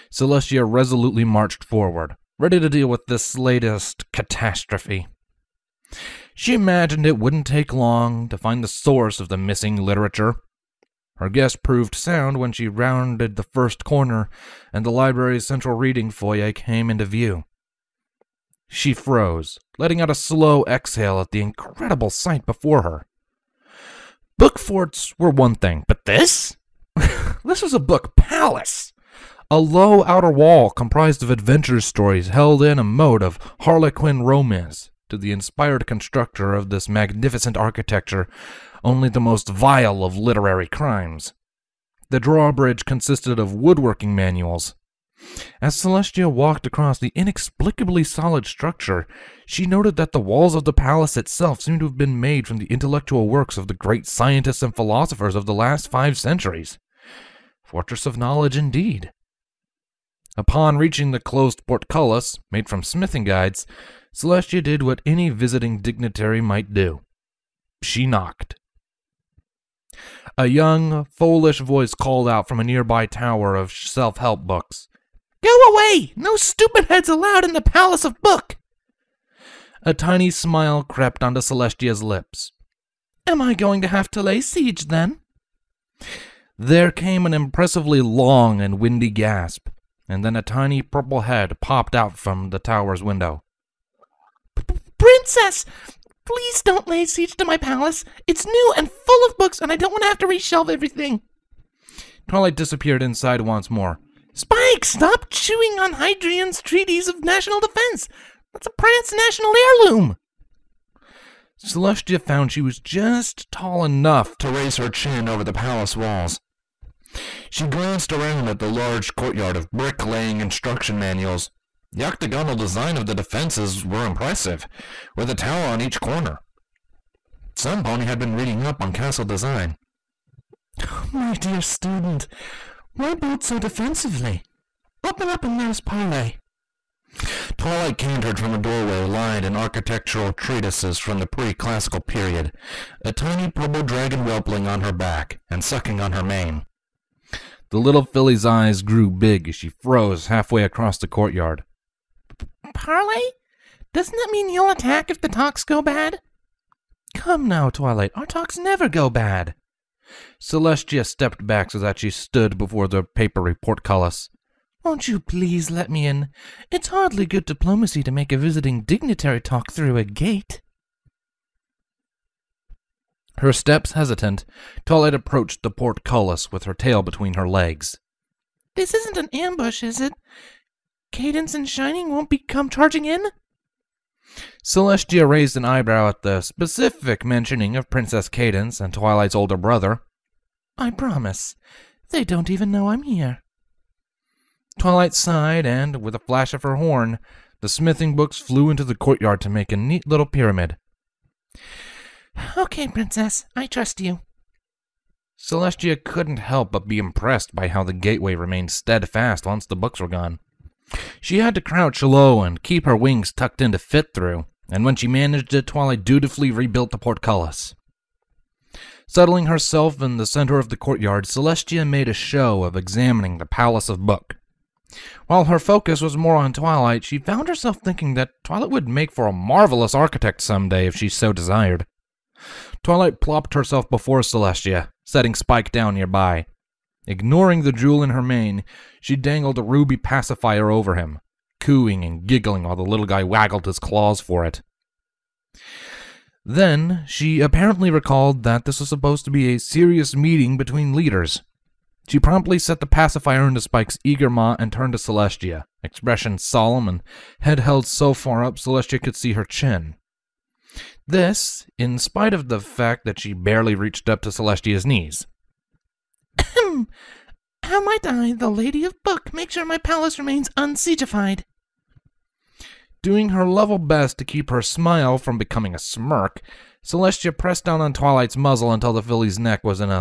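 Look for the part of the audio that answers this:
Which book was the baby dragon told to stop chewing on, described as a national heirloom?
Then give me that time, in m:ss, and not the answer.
1:45.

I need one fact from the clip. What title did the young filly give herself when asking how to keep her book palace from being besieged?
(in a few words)
Lady of Book.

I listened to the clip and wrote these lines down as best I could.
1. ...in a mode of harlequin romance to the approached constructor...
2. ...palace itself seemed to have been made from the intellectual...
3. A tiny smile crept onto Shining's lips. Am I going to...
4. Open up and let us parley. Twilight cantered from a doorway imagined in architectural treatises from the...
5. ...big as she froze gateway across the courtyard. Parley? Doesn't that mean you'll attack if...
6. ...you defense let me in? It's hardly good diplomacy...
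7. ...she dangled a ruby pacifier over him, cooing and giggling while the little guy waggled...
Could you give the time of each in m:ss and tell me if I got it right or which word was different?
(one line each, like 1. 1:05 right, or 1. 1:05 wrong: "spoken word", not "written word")
1. 0:32 wrong: "inspired", not "approached"
2. 0:50 right
3. 1:19 wrong: "Celestia", not "Shining"
4. 2:15 wrong: "lined", not "imagined"
5. 2:29 wrong: "halfway", not "gateway"
6. 2:45 wrong: "please", not "defense"
7. 3:59 right.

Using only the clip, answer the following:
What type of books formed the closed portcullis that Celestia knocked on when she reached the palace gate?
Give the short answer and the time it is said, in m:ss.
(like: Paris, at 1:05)
Smithing guides, at 1:02.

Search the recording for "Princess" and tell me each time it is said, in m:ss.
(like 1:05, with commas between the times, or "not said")
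1:34, 3:07, 3:22.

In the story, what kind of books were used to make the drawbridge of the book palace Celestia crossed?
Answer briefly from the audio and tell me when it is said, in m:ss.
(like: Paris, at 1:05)
Woodworking manuals, at 0:43.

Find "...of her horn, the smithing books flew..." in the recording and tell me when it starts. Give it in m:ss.
3:16.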